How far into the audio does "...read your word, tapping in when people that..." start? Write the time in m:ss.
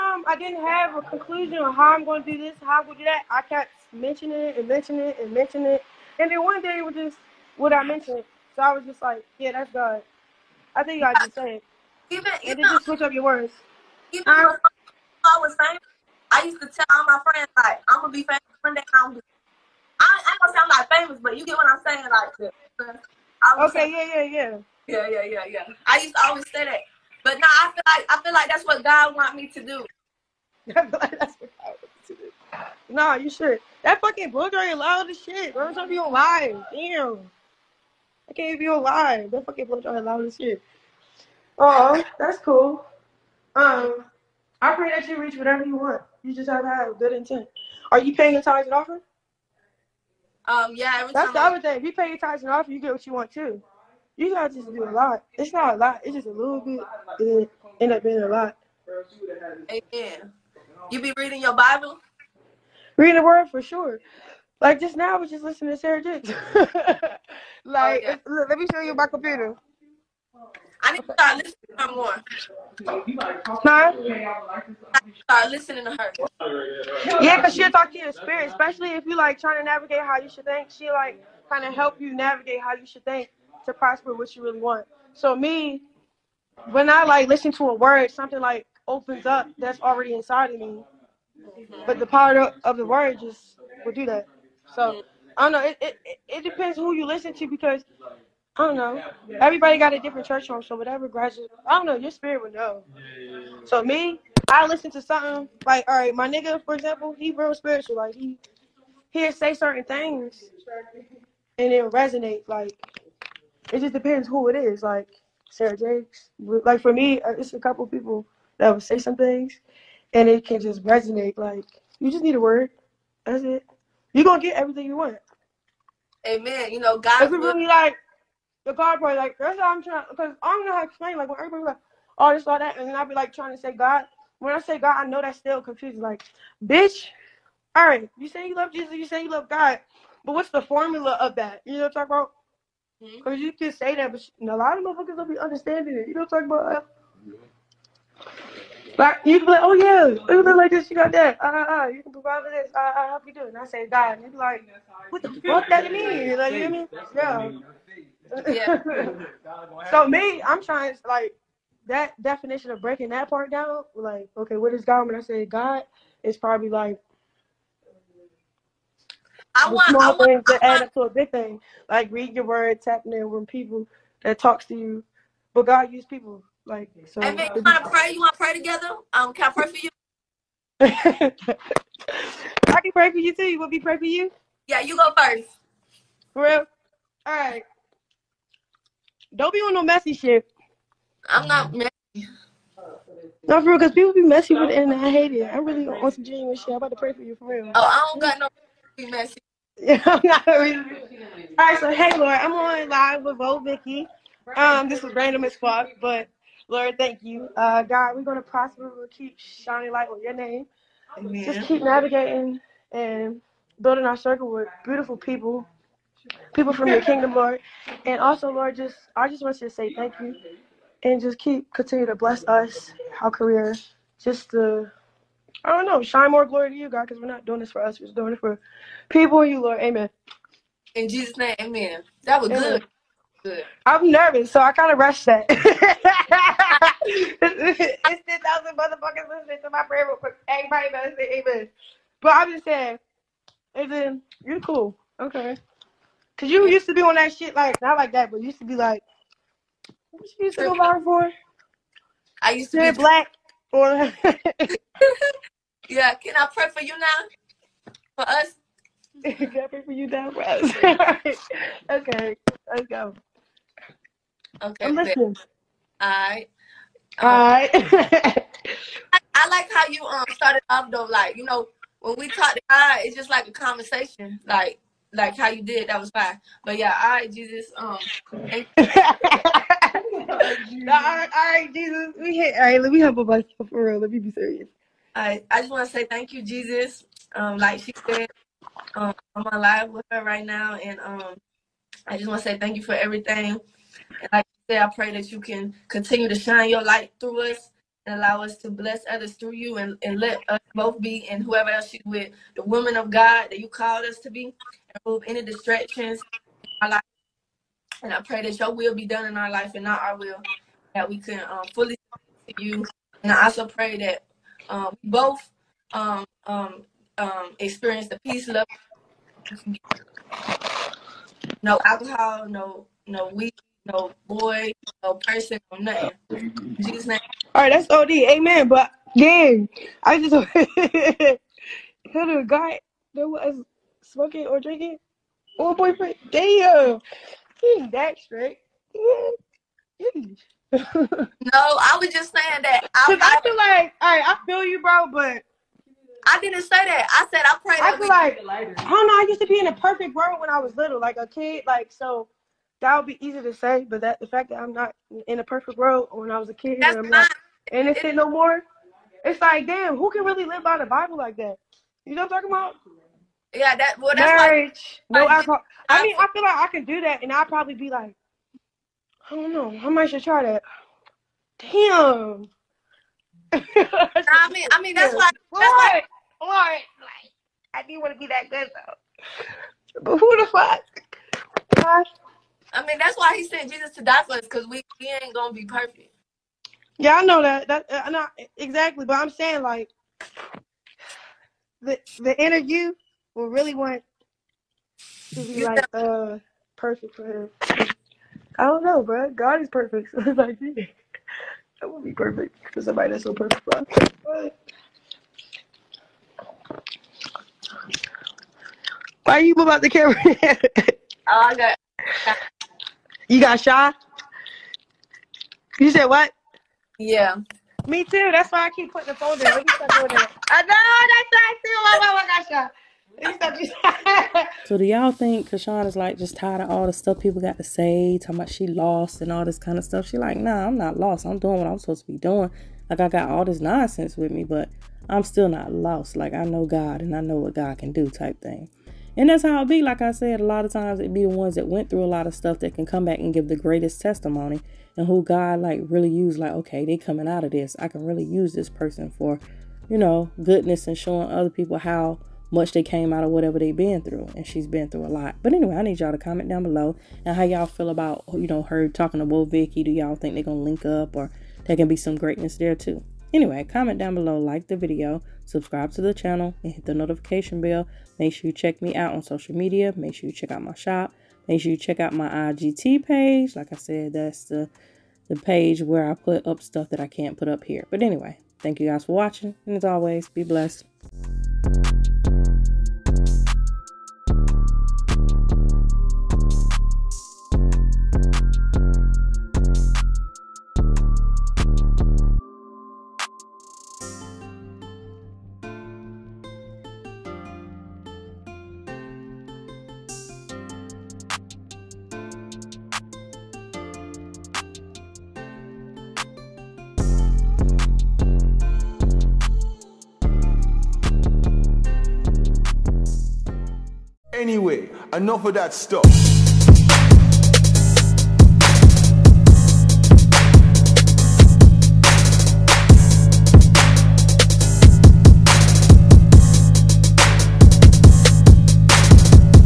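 2:52.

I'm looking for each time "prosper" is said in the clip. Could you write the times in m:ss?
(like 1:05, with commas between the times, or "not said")
1:23, 3:28.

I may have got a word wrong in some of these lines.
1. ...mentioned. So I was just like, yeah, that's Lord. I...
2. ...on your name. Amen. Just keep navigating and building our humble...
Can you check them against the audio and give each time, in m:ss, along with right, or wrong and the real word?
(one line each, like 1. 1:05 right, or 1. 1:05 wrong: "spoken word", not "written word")
1. 0:07 wrong: "God", not "Lord"
2. 3:30 wrong: "circle", not "humble".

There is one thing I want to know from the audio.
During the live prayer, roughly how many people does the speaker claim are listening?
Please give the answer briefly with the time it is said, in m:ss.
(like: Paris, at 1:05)
10,000, at 3:57.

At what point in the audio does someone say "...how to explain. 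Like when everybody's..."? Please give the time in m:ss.
2:10.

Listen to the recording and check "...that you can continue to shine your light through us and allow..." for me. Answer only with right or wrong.
right.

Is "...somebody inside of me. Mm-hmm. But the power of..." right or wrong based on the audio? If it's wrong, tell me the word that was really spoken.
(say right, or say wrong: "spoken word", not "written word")
wrong: "already", not "somebody".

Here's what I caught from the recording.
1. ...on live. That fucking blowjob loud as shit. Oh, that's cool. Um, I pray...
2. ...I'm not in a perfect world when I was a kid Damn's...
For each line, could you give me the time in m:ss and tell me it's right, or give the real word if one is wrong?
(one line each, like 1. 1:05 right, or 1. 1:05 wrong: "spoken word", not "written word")
1. 0:38 right
2. 5:54 wrong: "That", not "Damn".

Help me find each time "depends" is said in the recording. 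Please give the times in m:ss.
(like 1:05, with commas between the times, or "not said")
1:36, 1:53.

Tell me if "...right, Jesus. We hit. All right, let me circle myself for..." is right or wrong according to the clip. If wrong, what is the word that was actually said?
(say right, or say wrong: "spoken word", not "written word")
wrong: "humble", not "circle".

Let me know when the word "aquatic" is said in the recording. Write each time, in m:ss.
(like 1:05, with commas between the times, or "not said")
not said.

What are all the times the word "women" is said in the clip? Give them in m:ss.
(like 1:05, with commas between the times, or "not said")
5:02.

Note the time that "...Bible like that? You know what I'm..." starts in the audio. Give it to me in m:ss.
6:00.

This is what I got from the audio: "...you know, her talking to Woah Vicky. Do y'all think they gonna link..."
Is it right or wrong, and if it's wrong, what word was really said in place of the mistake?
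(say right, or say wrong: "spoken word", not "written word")
right.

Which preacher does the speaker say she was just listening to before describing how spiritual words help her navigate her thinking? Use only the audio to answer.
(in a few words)
Sarah Dix.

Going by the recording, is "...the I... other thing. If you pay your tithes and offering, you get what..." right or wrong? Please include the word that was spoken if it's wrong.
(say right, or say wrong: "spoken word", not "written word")
right.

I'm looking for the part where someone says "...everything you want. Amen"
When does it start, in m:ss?
2:04.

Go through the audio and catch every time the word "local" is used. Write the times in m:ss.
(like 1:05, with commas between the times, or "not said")
not said.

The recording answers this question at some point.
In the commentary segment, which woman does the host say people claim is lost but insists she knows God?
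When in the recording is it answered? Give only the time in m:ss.
7:05.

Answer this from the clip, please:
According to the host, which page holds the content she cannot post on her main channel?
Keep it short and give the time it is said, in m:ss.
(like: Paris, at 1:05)
IGT page, at 7:52.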